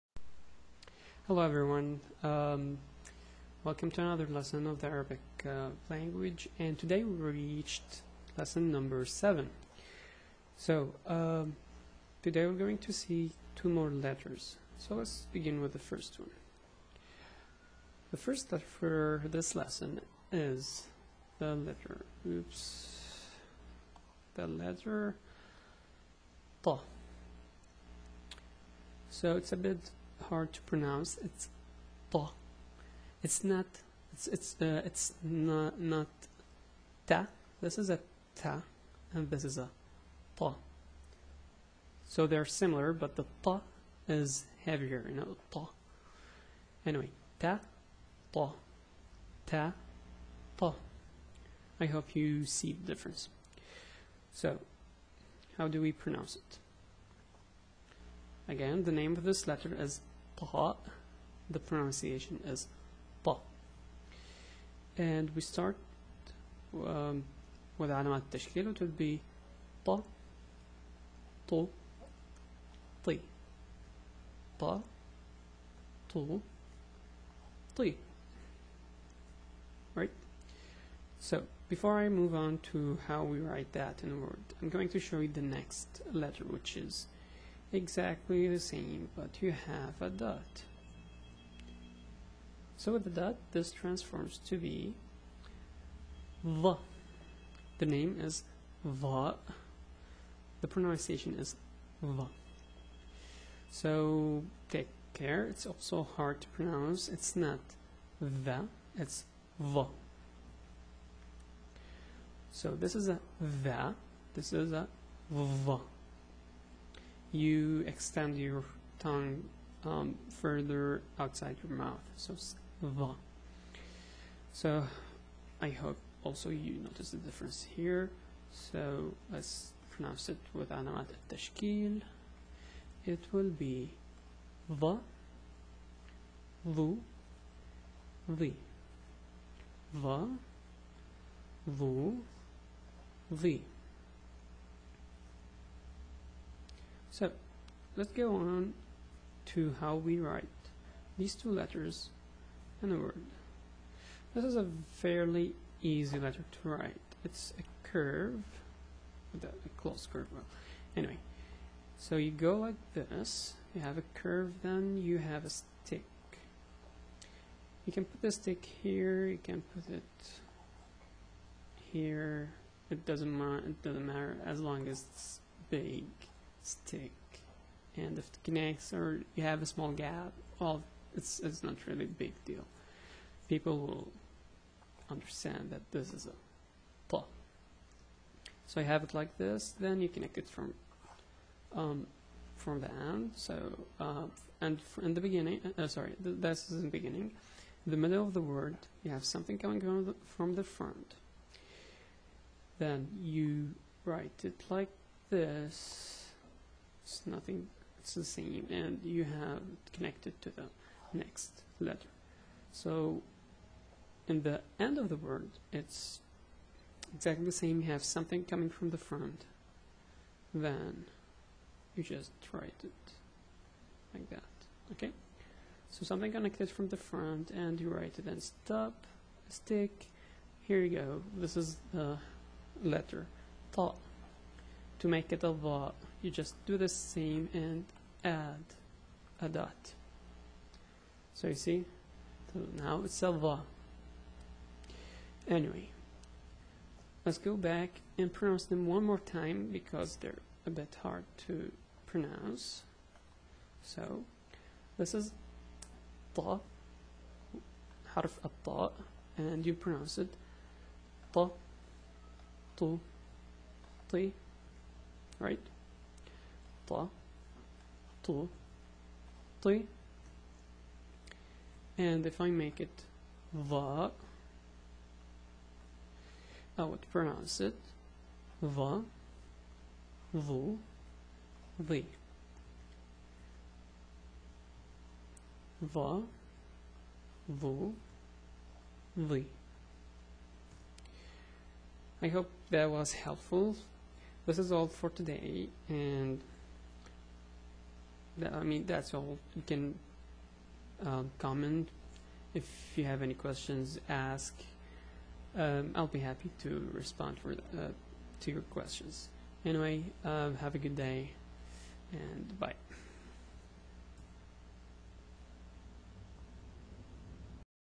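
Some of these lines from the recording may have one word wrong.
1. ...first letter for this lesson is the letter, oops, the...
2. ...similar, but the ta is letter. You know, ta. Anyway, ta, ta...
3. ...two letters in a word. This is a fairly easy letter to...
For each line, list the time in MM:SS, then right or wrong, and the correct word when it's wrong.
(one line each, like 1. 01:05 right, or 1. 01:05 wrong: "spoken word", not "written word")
1. 00:18 right
2. 00:42 wrong: "heavier", not "letter"
3. 02:31 right.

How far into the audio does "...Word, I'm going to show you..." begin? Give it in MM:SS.
01:24.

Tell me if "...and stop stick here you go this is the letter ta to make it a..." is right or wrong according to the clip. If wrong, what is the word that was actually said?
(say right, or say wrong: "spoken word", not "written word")
right.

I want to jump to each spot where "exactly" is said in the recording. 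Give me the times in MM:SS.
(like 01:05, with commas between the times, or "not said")
01:27, 03:37.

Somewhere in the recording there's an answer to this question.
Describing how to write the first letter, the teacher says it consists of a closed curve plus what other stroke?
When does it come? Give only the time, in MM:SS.
02:45.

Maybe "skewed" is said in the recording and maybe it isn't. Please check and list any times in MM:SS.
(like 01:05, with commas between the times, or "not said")
not said.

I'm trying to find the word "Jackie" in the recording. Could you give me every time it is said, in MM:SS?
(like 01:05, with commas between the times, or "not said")
not said.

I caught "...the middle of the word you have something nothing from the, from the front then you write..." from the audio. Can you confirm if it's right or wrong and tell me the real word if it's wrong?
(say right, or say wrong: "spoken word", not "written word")
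wrong: "coming", not "nothing".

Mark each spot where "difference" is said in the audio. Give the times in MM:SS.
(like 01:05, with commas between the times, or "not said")
00:52, 02:07.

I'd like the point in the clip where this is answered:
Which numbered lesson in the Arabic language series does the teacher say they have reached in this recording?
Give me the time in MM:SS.
00:08.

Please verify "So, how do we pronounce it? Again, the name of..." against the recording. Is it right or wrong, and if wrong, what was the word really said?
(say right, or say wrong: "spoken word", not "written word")
right.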